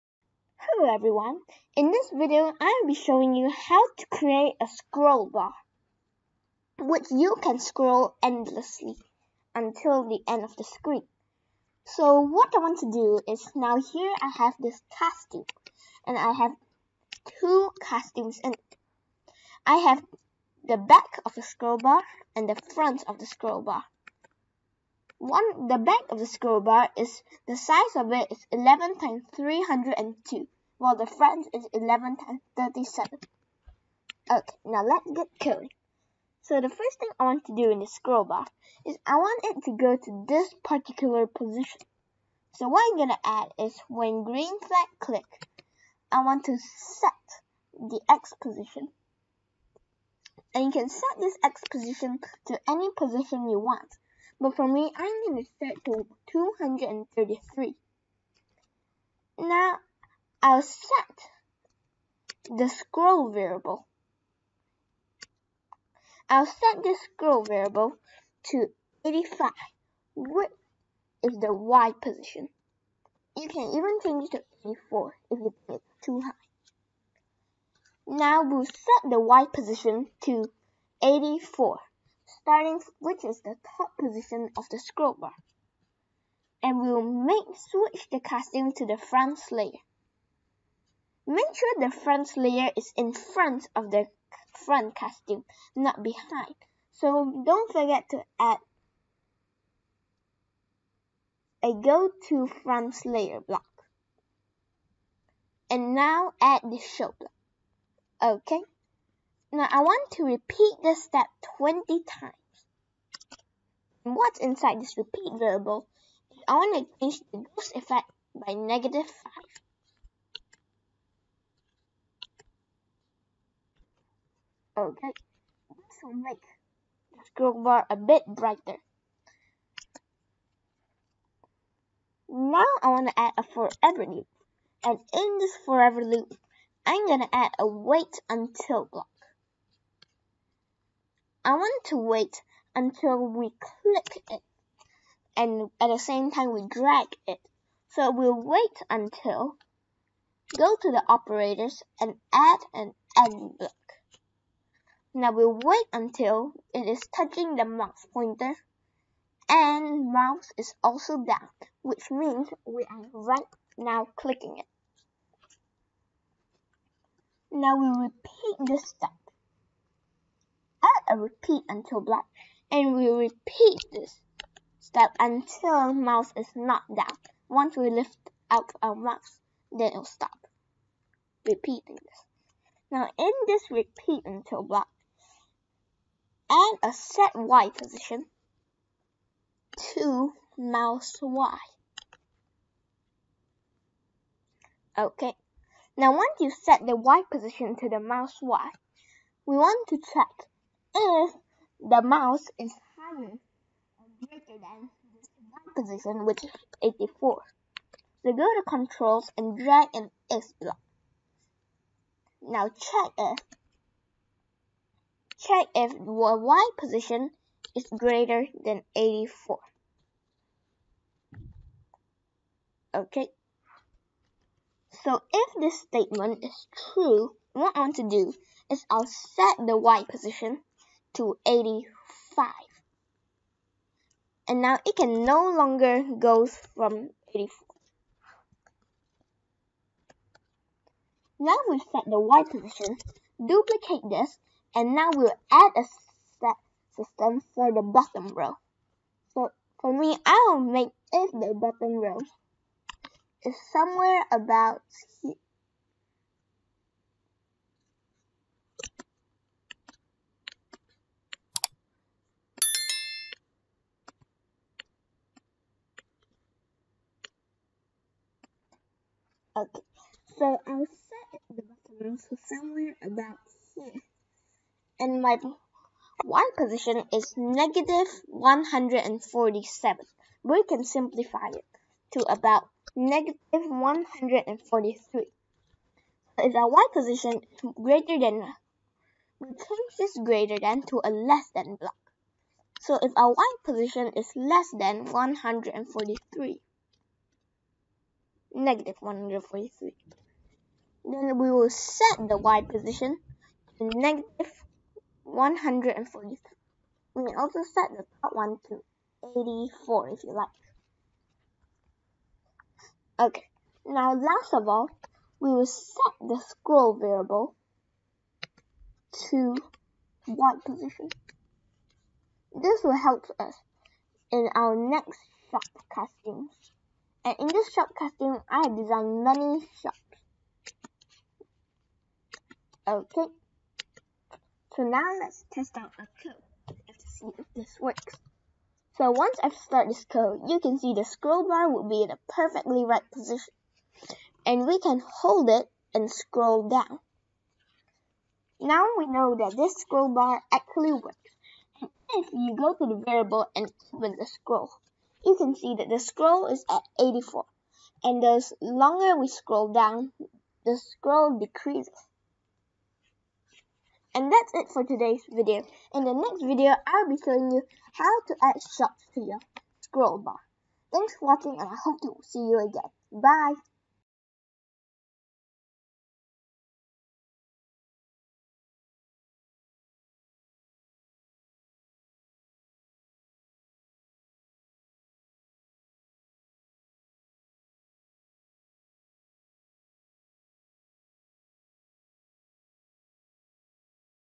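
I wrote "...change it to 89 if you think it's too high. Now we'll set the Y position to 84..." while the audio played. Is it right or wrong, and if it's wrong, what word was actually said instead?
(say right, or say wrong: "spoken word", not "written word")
wrong: "84", not "89".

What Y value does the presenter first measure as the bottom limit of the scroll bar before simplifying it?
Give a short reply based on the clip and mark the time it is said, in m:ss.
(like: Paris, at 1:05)
-147, at 4:37.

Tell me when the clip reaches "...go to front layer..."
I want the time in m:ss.
1:41.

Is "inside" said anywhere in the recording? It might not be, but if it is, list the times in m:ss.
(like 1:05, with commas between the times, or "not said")
1:54.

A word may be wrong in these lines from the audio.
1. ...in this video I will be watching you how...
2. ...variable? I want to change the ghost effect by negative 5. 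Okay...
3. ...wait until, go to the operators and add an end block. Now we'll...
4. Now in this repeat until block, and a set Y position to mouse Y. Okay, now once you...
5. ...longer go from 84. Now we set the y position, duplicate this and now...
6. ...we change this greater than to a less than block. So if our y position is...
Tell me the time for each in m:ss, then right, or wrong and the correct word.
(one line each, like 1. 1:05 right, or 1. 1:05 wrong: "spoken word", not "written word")
1. 0:01 wrong: "showing", not "watching"
2. 1:55 right
3. 2:28 right
4. 3:02 right
5. 3:55 right
6. 4:49 right.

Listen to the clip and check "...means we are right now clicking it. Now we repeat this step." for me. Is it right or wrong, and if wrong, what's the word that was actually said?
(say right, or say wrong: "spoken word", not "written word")
right.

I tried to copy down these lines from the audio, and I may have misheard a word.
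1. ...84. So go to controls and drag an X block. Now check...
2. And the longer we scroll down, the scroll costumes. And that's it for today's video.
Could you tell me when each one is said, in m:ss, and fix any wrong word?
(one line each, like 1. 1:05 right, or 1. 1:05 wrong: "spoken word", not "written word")
1. 3:26 right
2. 5:58 wrong: "decreases", not "costumes".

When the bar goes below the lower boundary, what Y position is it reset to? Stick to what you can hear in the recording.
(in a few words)
-140.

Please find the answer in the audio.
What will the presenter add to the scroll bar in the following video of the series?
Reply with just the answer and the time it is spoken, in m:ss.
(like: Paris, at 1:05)
shops, at 6:08.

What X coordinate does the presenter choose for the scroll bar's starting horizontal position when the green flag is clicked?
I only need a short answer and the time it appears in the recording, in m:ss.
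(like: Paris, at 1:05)
233, at 0:56.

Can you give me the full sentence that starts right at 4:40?
We can simplify it to about negative 143.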